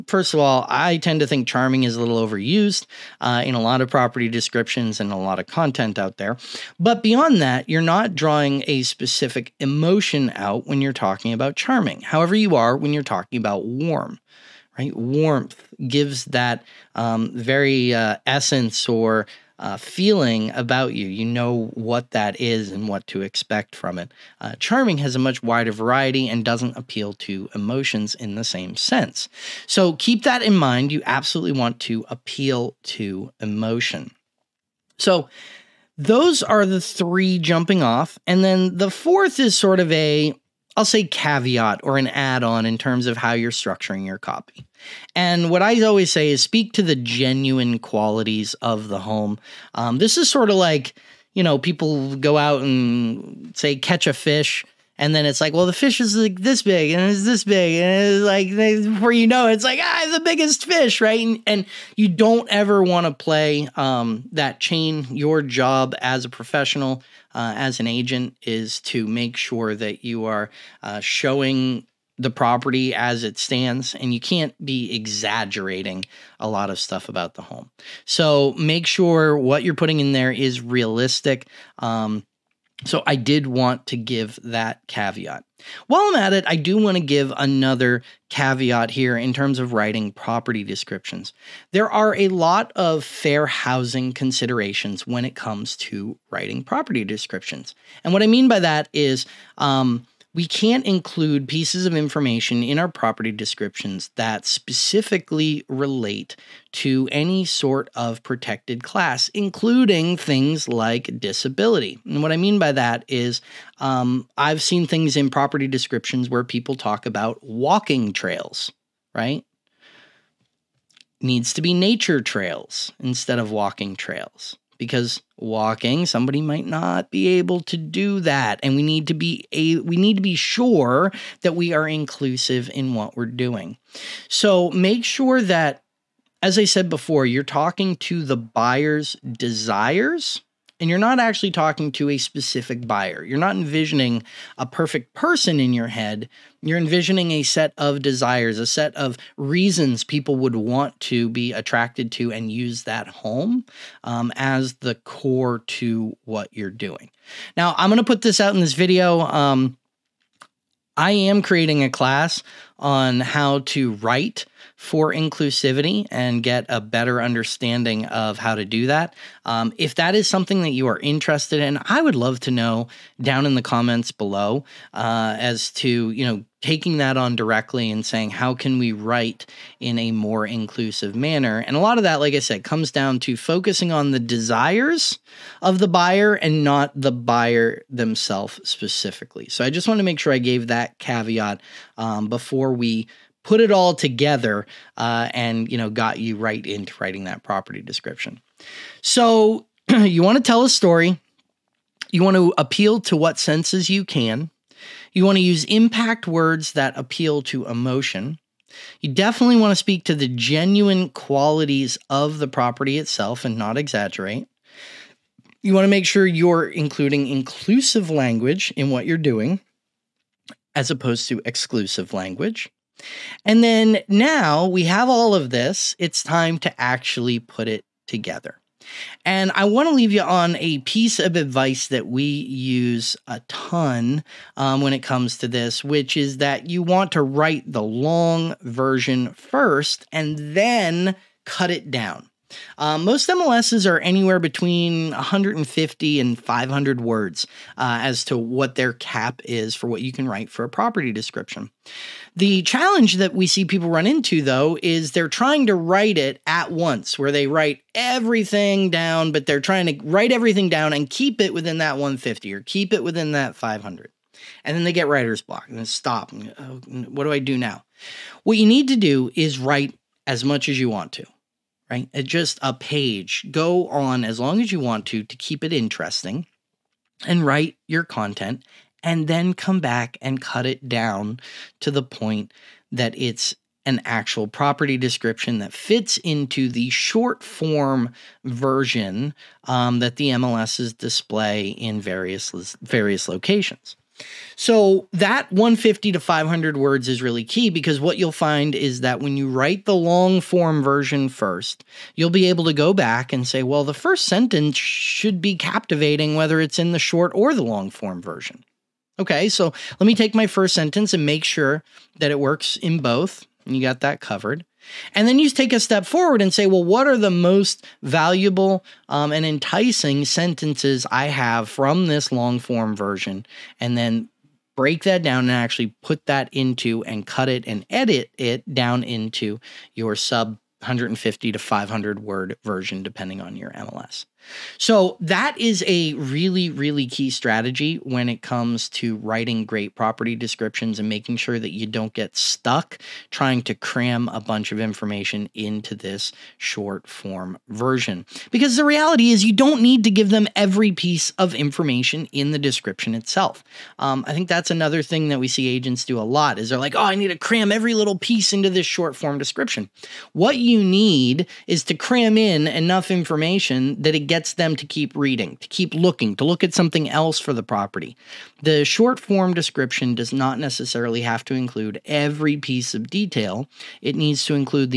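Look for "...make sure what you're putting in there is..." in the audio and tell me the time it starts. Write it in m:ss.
1:18.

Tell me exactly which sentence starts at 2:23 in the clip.
You're not envisioning a perfect person in your head.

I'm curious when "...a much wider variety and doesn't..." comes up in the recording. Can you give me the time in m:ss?
0:25.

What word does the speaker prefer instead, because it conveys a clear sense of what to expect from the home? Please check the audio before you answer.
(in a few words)
warm.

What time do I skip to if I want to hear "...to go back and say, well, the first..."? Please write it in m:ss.
5:02.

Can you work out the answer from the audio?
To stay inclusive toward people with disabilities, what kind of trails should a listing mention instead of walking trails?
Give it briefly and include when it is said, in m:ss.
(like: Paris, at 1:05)
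nature trails, at 2:01.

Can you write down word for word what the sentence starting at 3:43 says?
And then now we have all of this, it's time to actually put it together.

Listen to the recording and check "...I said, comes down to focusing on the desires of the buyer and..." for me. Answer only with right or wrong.
right.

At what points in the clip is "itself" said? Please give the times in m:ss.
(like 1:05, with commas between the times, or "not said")
3:32, 5:53.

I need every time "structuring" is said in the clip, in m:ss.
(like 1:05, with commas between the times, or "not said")
0:43.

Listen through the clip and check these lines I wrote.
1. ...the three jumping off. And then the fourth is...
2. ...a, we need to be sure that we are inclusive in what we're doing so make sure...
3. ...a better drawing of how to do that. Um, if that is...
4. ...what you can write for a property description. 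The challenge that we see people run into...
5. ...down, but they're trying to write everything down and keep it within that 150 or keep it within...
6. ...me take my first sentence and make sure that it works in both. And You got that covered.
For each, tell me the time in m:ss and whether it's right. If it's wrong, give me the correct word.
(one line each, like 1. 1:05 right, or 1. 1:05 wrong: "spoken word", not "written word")
1. 0:36 right
2. 2:09 right
3. 2:46 wrong: "understanding", not "drawing"
4. 4:09 right
5. 4:18 right
6. 5:10 right.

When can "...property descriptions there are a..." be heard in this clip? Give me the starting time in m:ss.
1:30.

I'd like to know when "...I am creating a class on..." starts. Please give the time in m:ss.
2:40.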